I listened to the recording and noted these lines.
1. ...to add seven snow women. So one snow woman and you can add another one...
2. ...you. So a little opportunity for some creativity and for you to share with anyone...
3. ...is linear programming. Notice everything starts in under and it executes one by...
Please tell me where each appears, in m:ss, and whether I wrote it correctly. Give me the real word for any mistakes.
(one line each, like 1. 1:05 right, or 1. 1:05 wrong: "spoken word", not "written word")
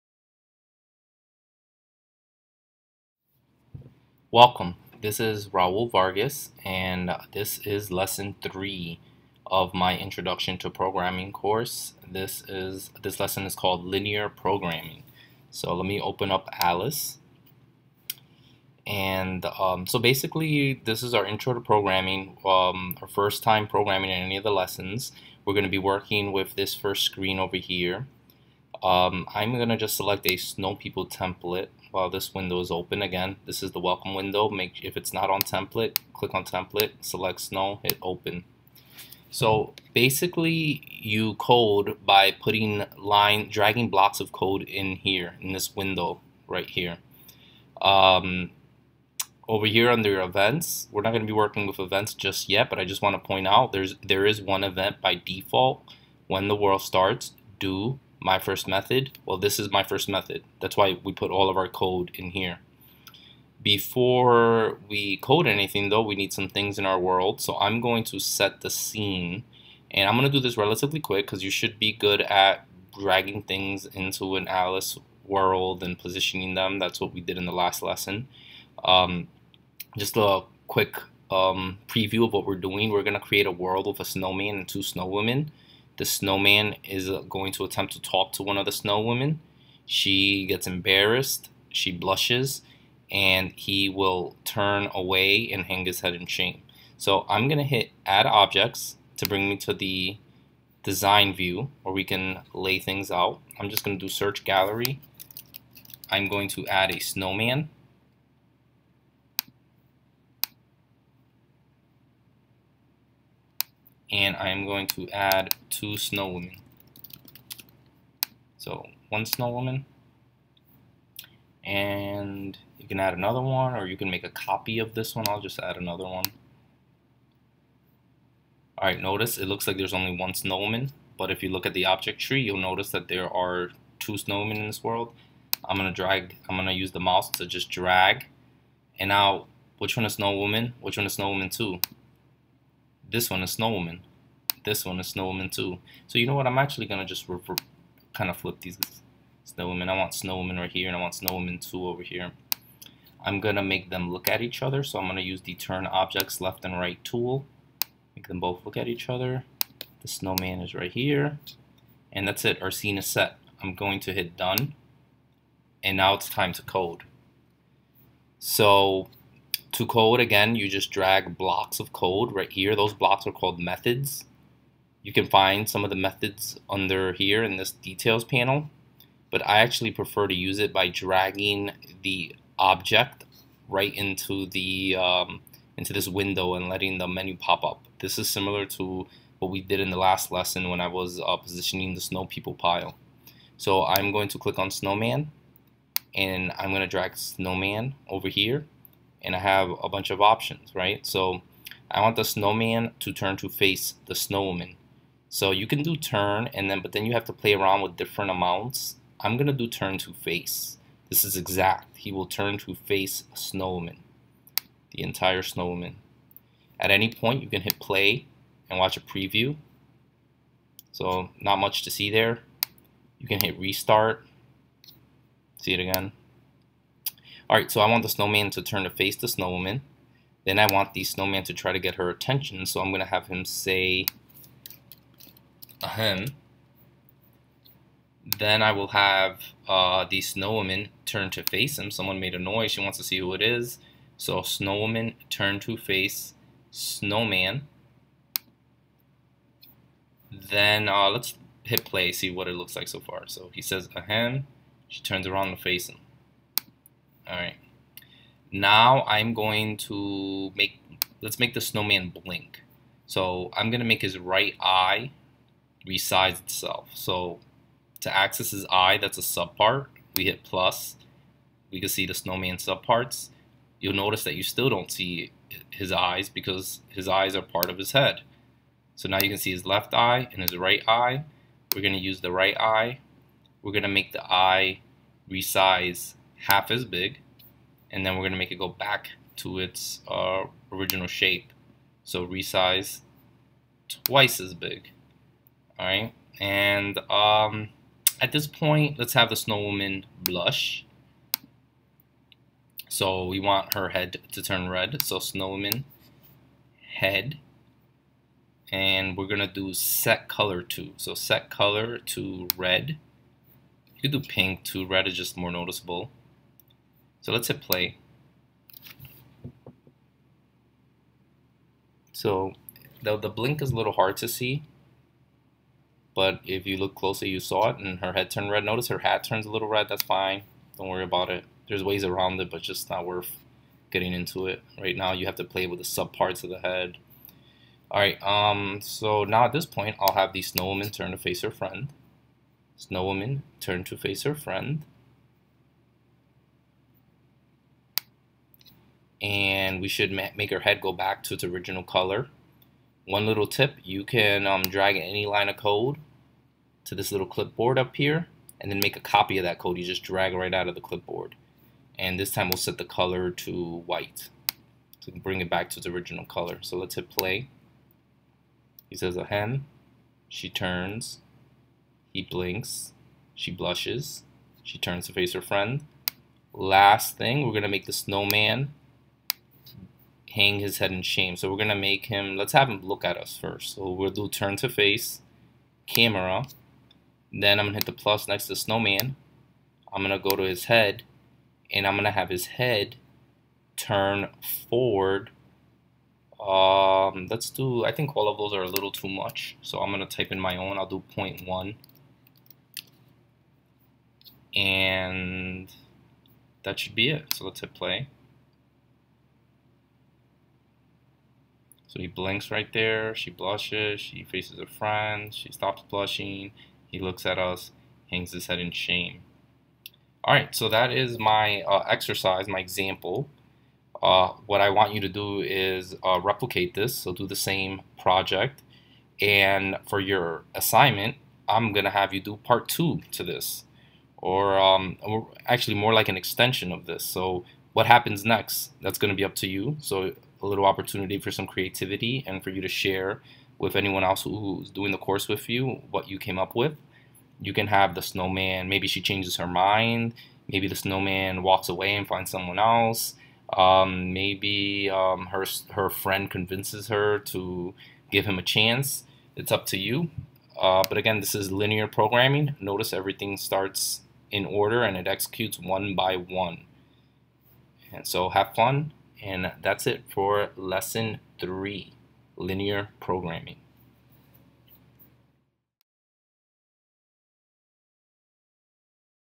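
1. 1:54 wrong: "two", not "seven"
2. 7:19 right
3. 7:41 wrong: "order", not "under".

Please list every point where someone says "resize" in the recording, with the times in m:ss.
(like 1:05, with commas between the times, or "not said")
4:25, 4:45, 4:52.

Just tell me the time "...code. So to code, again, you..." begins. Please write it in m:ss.
2:46.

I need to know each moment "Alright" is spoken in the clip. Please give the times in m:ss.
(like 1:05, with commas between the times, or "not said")
2:08, 3:47, 7:00.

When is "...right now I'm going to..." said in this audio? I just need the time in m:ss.
4:17.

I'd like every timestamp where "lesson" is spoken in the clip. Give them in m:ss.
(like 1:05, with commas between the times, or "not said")
0:07, 0:13, 0:24, 1:17, 3:10, 7:50.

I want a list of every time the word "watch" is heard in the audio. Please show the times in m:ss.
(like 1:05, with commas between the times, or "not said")
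3:38.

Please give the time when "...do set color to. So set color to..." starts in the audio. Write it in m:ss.
5:09.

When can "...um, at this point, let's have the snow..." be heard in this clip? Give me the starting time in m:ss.
4:57.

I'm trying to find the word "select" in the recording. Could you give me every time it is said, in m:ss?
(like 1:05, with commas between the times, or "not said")
0:29, 0:37.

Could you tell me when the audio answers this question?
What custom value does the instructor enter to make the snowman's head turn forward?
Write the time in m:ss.
6:41.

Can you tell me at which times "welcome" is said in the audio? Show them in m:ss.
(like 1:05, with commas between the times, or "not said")
0:04, 0:33.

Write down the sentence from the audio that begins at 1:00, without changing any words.
That's why we put all of our code in here.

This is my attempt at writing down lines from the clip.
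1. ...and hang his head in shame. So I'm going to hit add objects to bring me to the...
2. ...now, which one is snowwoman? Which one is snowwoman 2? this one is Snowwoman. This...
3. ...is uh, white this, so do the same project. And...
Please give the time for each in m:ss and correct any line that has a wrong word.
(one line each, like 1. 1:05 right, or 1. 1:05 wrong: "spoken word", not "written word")
1. 1:35 right
2. 2:19 right
3. 7:05 wrong: "replicate", not "white".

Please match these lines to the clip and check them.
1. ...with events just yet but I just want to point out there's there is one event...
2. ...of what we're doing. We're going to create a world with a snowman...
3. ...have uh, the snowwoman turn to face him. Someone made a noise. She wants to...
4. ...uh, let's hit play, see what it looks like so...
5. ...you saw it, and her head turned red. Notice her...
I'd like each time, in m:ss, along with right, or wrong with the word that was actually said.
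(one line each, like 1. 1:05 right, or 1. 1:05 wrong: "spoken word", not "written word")
1. 0:51 right
2. 1:22 right
3. 3:58 right
4. 4:10 right
5. 5:27 right.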